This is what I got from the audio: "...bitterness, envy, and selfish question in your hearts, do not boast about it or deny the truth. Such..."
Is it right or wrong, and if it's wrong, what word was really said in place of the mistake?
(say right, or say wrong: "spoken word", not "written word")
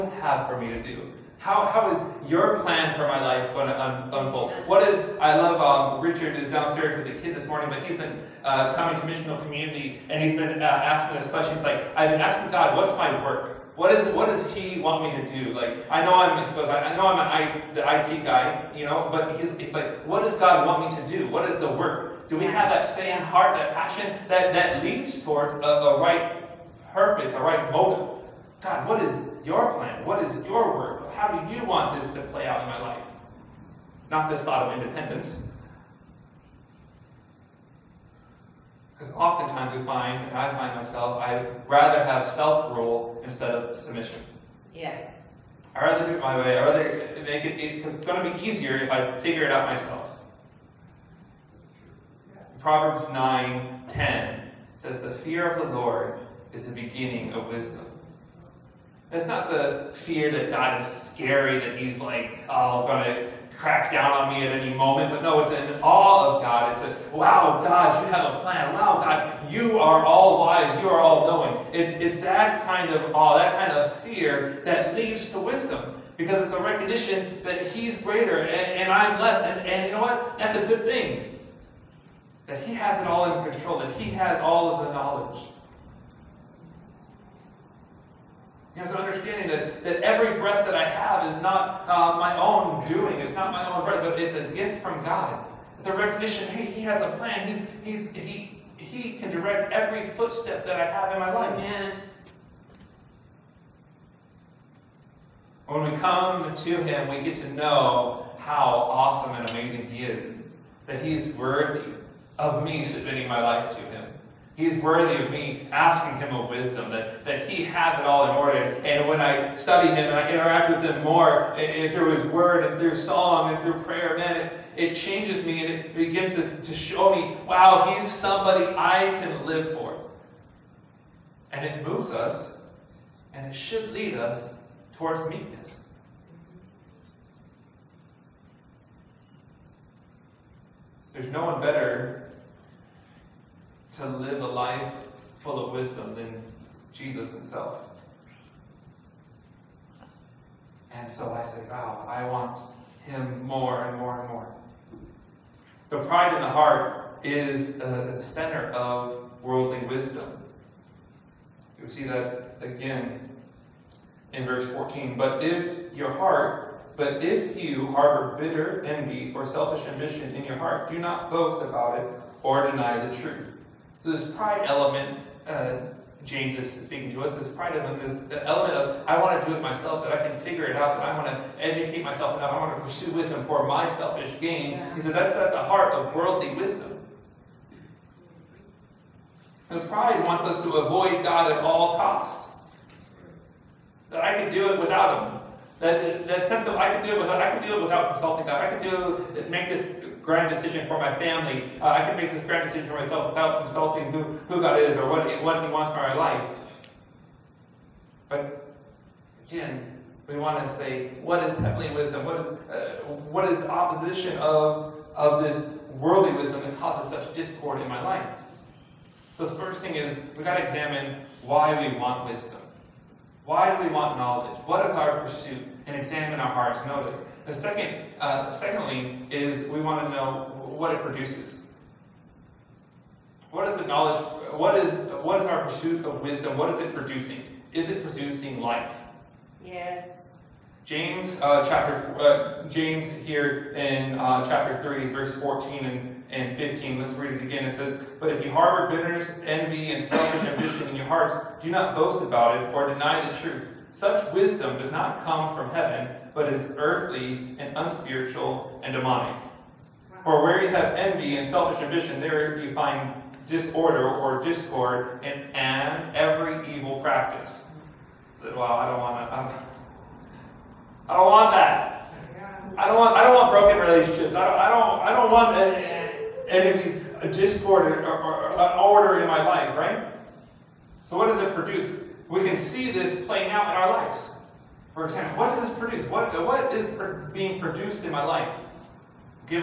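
wrong: "ambition", not "question".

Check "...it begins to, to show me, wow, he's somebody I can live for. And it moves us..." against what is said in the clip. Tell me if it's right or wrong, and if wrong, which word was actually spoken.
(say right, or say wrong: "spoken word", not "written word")
right.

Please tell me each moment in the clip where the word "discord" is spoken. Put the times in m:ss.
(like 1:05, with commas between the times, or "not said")
3:37, 4:24, 4:37.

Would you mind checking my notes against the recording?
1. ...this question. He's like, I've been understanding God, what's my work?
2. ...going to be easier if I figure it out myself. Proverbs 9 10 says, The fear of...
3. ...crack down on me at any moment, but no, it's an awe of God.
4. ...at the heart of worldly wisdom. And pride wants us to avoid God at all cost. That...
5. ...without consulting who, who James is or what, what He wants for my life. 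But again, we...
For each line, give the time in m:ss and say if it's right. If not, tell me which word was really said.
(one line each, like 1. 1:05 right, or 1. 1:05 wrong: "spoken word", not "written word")
1. 0:11 wrong: "asking", not "understanding"
2. 0:47 right
3. 1:03 right
4. 3:05 right
5. 3:23 wrong: "God", not "James".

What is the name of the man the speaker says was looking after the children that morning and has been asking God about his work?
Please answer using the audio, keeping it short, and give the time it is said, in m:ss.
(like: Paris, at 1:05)
Richard, at 0:06.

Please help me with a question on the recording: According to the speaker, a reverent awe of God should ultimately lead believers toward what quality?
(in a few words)
meekness.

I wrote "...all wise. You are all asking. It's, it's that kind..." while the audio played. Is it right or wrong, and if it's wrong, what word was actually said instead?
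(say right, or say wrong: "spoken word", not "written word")
wrong: "knowing", not "asking".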